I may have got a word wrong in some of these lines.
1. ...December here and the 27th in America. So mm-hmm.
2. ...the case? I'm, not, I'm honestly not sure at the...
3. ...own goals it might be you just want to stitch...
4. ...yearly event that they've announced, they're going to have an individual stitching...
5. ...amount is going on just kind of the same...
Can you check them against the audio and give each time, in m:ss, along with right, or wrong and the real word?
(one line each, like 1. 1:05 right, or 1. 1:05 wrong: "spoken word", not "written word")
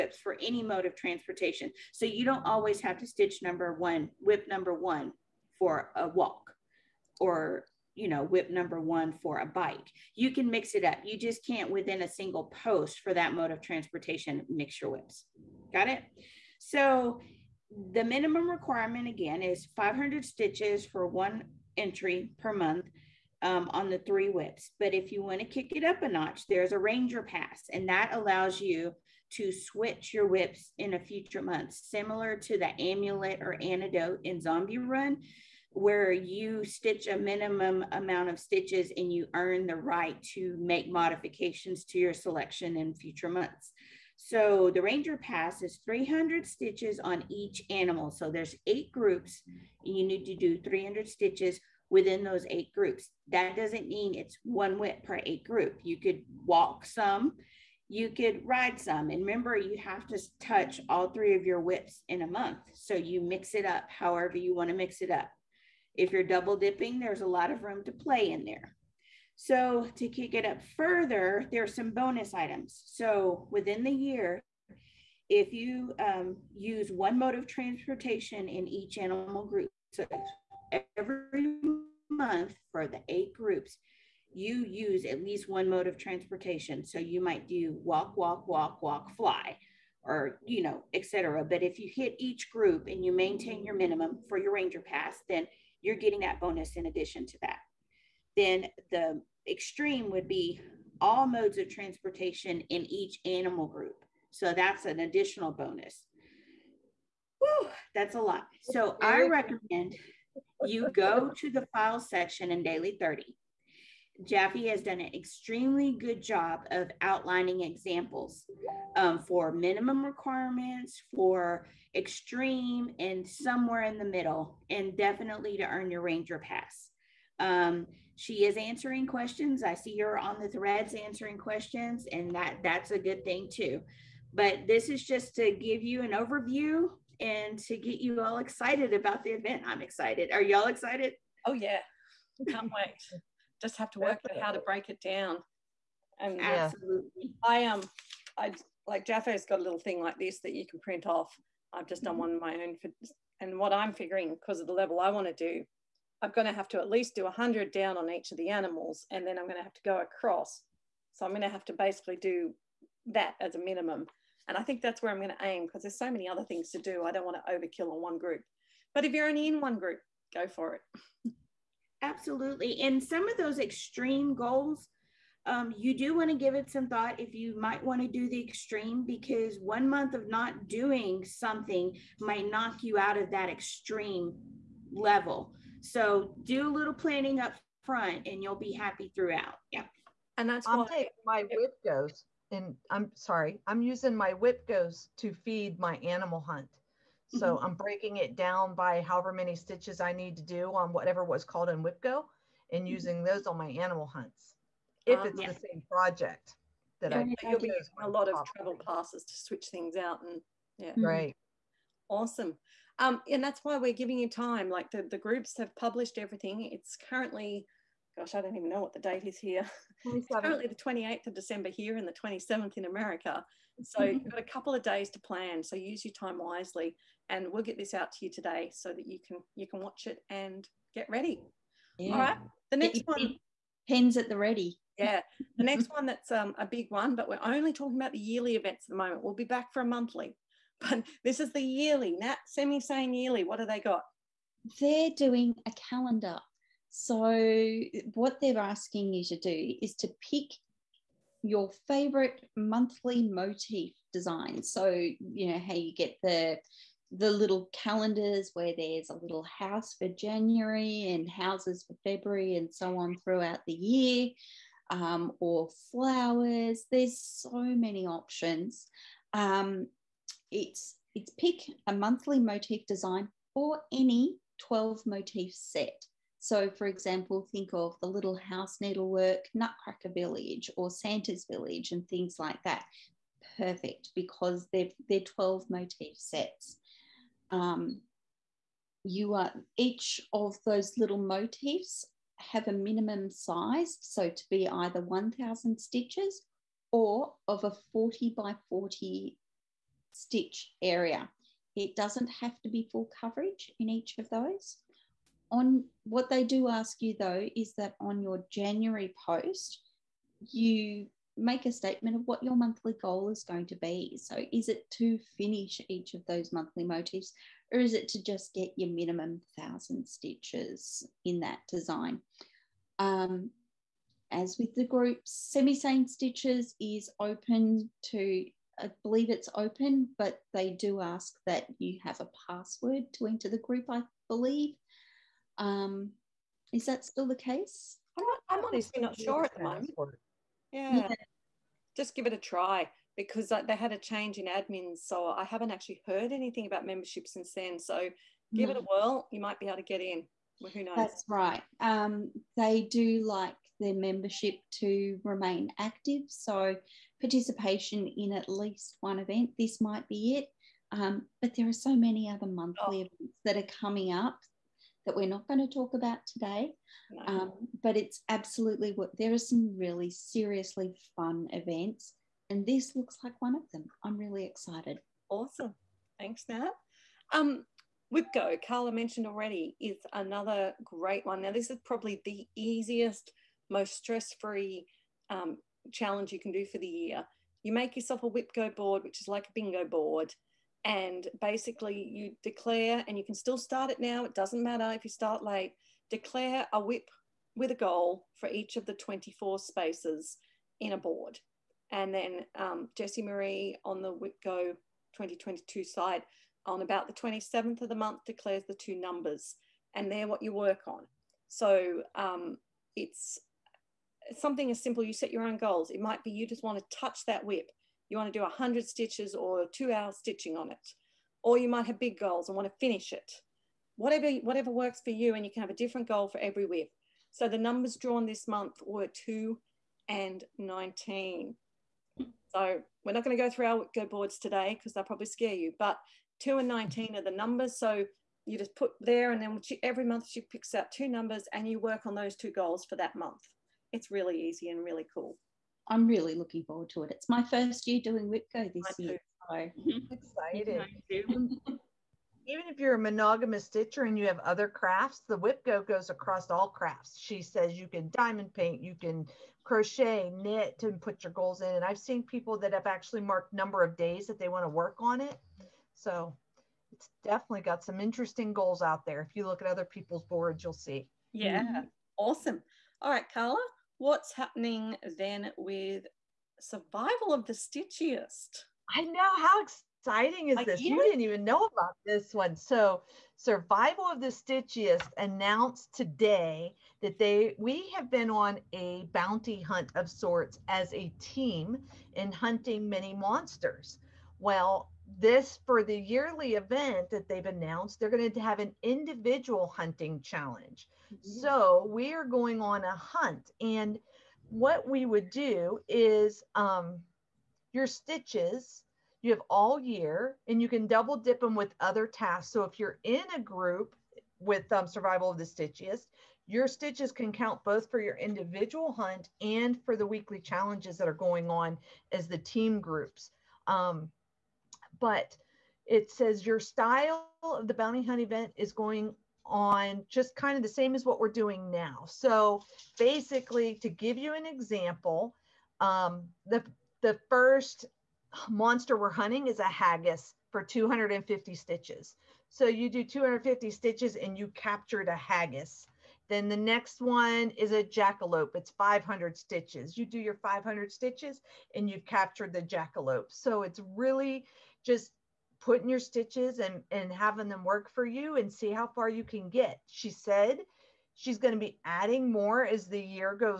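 1. 3:41 right
2. 5:37 right
3. 6:55 wrong: "touch", not "stitch"
4. 8:15 wrong: "hunting", not "stitching"
5. 8:48 wrong: "event", not "amount".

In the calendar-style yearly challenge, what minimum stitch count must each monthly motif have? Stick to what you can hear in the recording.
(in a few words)
1000.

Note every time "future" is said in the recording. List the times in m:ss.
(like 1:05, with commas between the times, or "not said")
0:30, 0:42.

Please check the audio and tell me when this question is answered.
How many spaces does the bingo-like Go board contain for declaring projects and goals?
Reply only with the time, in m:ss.
6:38.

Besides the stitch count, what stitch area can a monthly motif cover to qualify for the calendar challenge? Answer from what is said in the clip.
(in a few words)
40 by 40.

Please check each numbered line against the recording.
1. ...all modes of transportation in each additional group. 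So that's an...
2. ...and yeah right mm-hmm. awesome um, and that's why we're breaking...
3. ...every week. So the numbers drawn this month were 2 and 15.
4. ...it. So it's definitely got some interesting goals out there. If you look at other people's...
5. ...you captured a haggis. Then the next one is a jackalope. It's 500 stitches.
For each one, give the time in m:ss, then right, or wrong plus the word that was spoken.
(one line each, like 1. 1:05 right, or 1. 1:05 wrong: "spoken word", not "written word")
1. 1:41 wrong: "animal", not "additional"
2. 3:30 wrong: "giving", not "breaking"
3. 7:06 wrong: "19", not "15"
4. 7:45 right
5. 9:04 right.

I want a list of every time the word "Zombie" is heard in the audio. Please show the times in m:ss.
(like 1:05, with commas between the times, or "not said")
0:34.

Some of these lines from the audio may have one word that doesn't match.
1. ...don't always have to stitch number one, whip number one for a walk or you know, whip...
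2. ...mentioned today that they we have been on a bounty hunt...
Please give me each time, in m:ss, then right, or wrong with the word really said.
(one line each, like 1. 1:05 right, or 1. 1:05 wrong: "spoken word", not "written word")
1. 0:02 right
2. 8:05 wrong: "announced", not "mentioned".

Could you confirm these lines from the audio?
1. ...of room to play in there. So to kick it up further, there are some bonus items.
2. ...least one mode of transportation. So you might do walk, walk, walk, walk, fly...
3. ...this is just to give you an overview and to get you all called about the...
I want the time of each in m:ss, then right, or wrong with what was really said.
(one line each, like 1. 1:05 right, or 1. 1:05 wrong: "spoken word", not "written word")
1. 1:07 right
2. 1:25 right
3. 2:14 wrong: "excited", not "called".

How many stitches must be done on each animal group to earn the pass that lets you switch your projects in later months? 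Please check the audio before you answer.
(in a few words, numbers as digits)
300.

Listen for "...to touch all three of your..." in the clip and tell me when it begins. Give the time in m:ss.
1:00.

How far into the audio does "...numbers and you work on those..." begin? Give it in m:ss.
7:21.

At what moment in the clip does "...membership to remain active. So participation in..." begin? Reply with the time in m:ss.
5:53.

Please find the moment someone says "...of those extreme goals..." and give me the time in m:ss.
2:53.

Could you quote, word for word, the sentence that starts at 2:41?
So I'm going to have to basically do that as a minimum.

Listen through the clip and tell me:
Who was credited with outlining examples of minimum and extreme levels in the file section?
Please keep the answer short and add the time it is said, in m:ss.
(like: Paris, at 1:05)
Jaffe, at 1:54.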